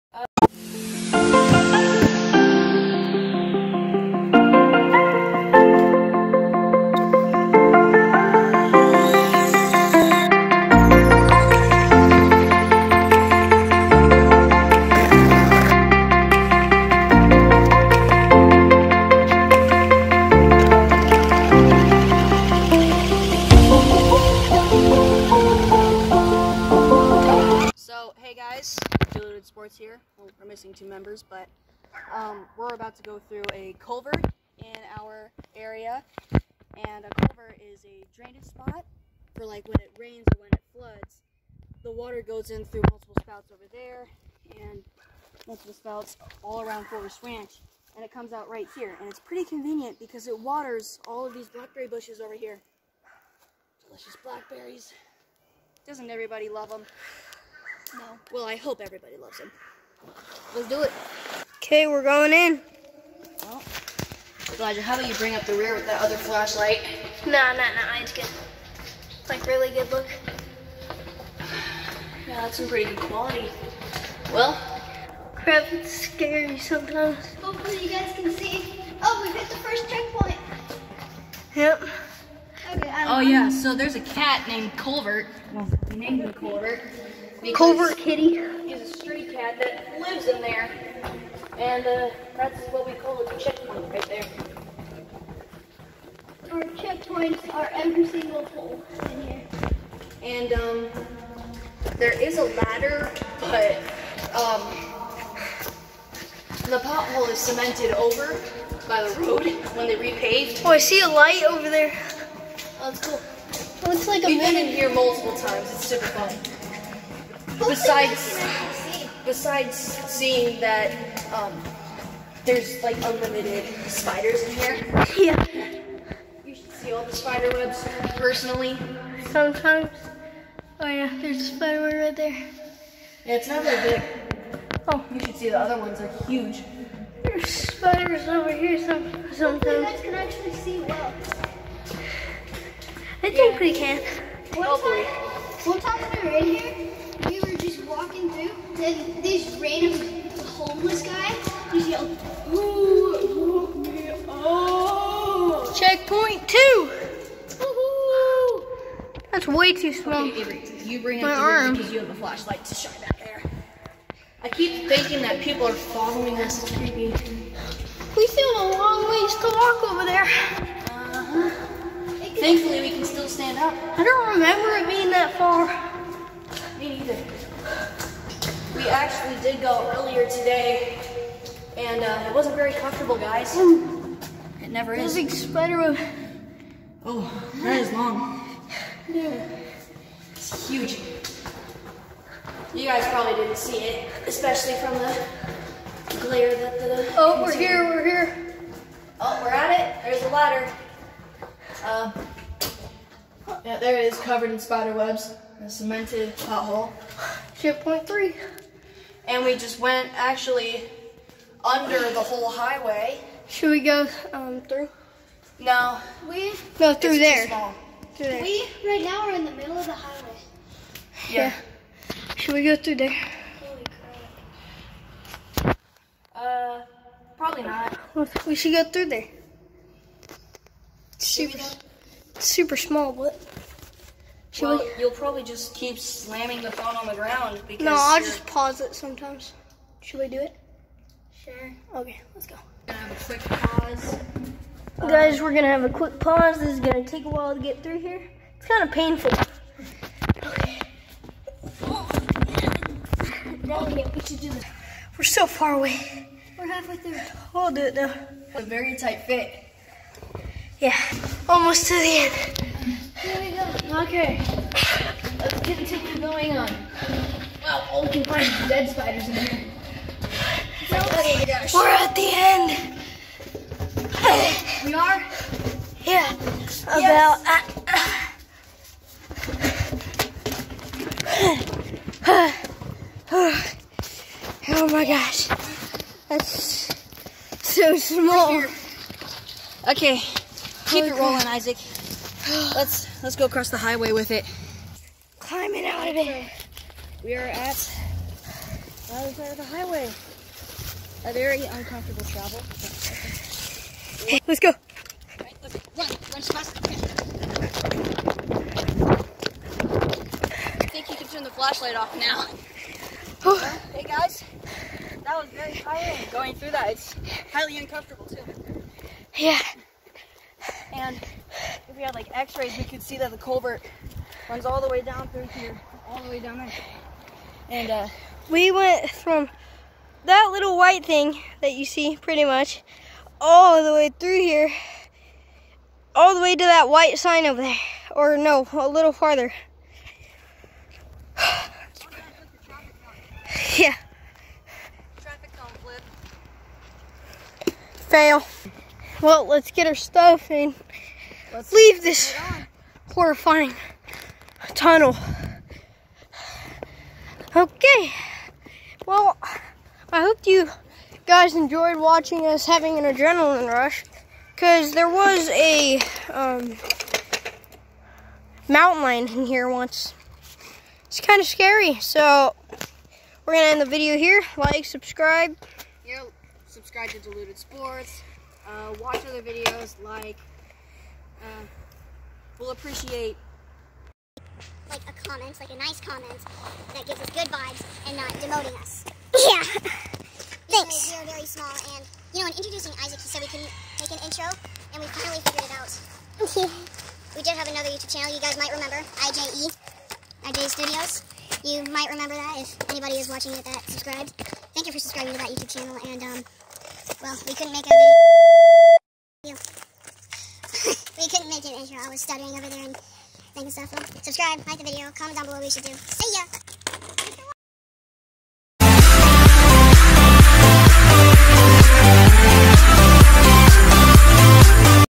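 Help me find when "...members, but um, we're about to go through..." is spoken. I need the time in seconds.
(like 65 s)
30 s.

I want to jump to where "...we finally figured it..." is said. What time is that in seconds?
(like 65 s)
395 s.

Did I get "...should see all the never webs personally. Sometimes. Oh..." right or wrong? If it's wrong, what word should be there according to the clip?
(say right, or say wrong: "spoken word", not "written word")
wrong: "spider", not "never".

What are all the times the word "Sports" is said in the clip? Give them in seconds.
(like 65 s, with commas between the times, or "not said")
29 s, 377 s.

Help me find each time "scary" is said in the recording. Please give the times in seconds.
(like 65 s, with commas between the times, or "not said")
75 s, 371 s.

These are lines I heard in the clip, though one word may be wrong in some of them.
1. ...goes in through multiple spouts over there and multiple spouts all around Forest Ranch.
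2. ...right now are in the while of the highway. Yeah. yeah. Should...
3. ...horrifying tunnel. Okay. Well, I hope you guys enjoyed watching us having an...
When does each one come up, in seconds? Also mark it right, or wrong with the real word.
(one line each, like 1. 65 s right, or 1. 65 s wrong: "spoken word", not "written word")
1. 42 s right
2. 218 s wrong: "middle", not "while"
3. 353 s right.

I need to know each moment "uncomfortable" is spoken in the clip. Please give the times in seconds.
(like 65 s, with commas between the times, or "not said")
301 s, 317 s.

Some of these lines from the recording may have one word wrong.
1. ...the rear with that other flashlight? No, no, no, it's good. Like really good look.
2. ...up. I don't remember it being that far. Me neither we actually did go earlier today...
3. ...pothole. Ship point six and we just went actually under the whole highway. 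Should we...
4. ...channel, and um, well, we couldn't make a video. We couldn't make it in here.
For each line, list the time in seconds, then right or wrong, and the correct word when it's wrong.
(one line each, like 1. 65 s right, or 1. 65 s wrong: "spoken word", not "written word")
1. 65 s right
2. 173 s right
3. 206 s wrong: "three", not "six"
4. 405 s right.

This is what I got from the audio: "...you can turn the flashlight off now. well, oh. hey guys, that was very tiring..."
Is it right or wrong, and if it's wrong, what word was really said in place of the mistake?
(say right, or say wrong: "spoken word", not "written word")
right.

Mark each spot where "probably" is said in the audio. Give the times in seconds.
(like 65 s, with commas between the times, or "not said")
193 s, 227 s, 235 s.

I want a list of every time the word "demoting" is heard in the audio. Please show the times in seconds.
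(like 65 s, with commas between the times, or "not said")
388 s.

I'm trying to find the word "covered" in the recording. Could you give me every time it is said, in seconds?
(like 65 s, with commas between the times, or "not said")
204 s.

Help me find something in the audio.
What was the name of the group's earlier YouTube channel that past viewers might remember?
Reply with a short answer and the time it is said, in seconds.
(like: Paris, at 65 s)
IJ Studios, at 400 s.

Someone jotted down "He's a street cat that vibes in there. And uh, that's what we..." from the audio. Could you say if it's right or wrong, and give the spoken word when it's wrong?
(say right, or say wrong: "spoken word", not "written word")
wrong: "lives", not "vibes".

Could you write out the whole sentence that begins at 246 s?
This is gonna take a while to get through here.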